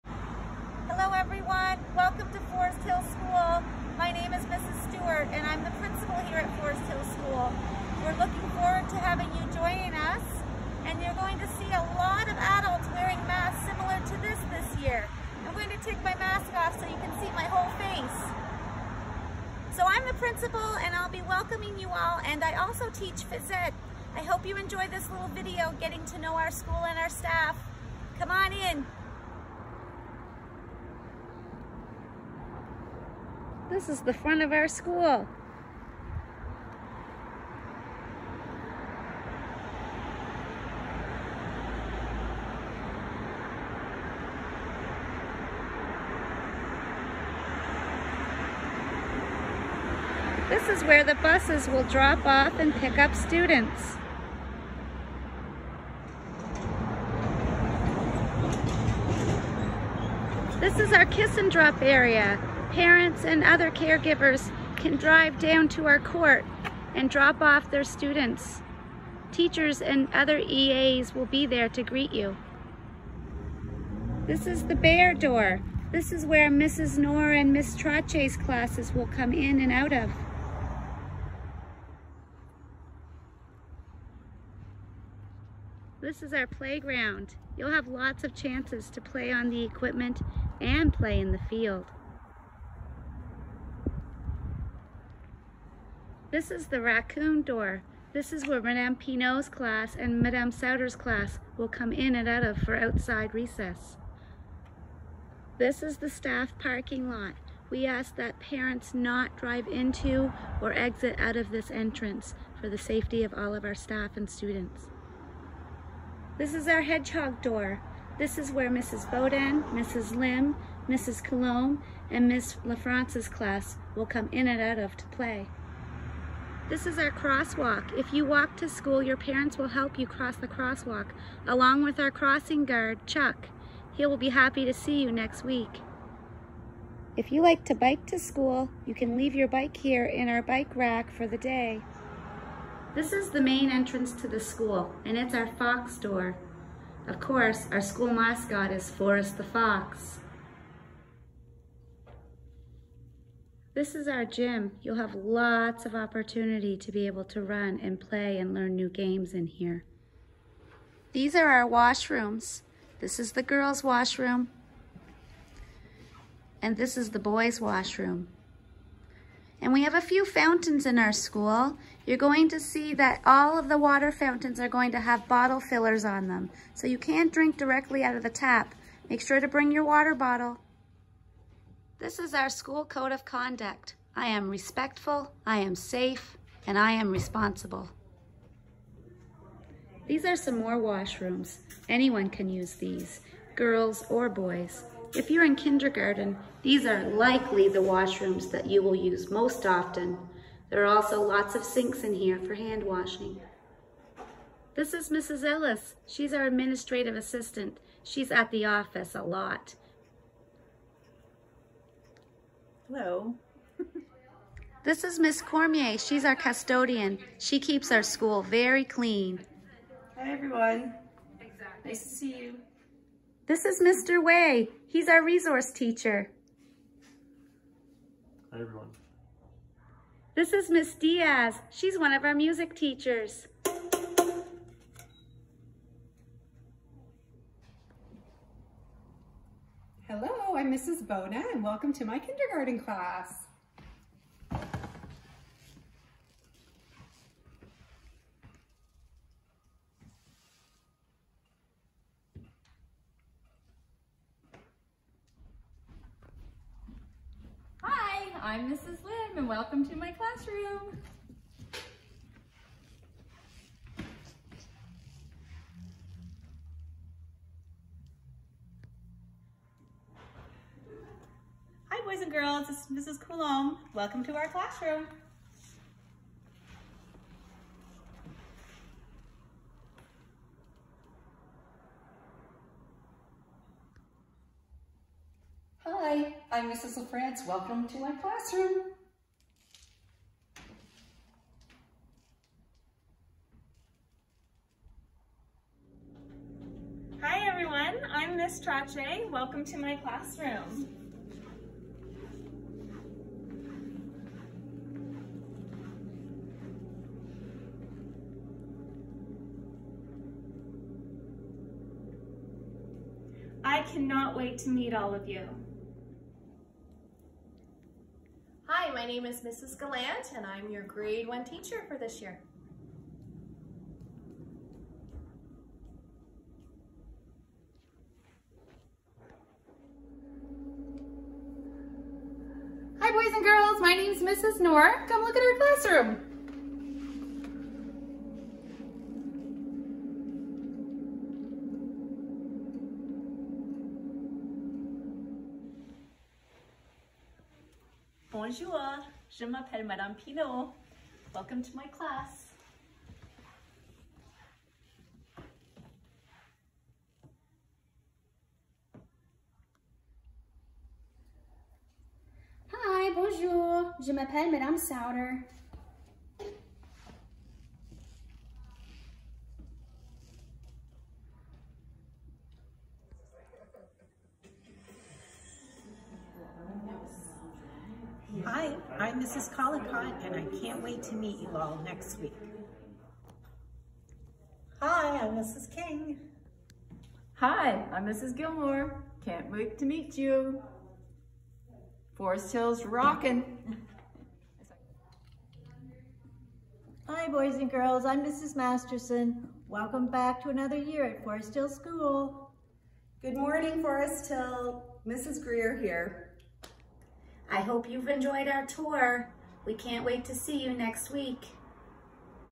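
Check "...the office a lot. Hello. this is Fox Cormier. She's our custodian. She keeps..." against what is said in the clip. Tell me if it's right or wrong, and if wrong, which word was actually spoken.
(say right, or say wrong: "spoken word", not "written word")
wrong: "Miss", not "Fox".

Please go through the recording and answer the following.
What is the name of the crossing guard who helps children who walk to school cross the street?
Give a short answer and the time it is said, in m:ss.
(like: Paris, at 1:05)
Chuck, at 2:13.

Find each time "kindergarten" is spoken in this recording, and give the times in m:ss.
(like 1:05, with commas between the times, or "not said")
3:15, 4:02.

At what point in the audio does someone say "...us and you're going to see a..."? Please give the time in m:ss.
0:09.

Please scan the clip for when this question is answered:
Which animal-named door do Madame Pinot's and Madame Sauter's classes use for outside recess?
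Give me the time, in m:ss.
1:36.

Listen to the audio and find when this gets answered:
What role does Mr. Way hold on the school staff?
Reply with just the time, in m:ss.
3:45.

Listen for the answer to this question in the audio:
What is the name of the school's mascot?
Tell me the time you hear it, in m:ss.
2:28.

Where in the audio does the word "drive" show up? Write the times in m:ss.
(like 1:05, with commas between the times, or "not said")
1:04, 1:49.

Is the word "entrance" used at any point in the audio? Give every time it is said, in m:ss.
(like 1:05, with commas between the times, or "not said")
1:51, 2:23.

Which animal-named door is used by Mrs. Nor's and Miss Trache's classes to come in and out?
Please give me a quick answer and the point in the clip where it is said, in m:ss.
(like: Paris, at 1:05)
Bear door, at 1:14.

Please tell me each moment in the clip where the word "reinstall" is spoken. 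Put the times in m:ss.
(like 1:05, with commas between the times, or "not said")
not said.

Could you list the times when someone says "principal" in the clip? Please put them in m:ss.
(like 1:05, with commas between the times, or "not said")
0:05, 0:20.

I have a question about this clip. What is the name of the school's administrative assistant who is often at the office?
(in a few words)
Mrs. Ellis.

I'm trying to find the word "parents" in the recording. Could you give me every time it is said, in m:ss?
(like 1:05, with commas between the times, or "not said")
1:02, 1:48, 2:09.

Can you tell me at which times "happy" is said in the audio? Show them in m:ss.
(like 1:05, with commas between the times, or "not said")
2:14.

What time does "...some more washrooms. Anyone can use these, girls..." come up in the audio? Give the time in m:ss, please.
3:10.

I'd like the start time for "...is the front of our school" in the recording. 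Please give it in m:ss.
0:33.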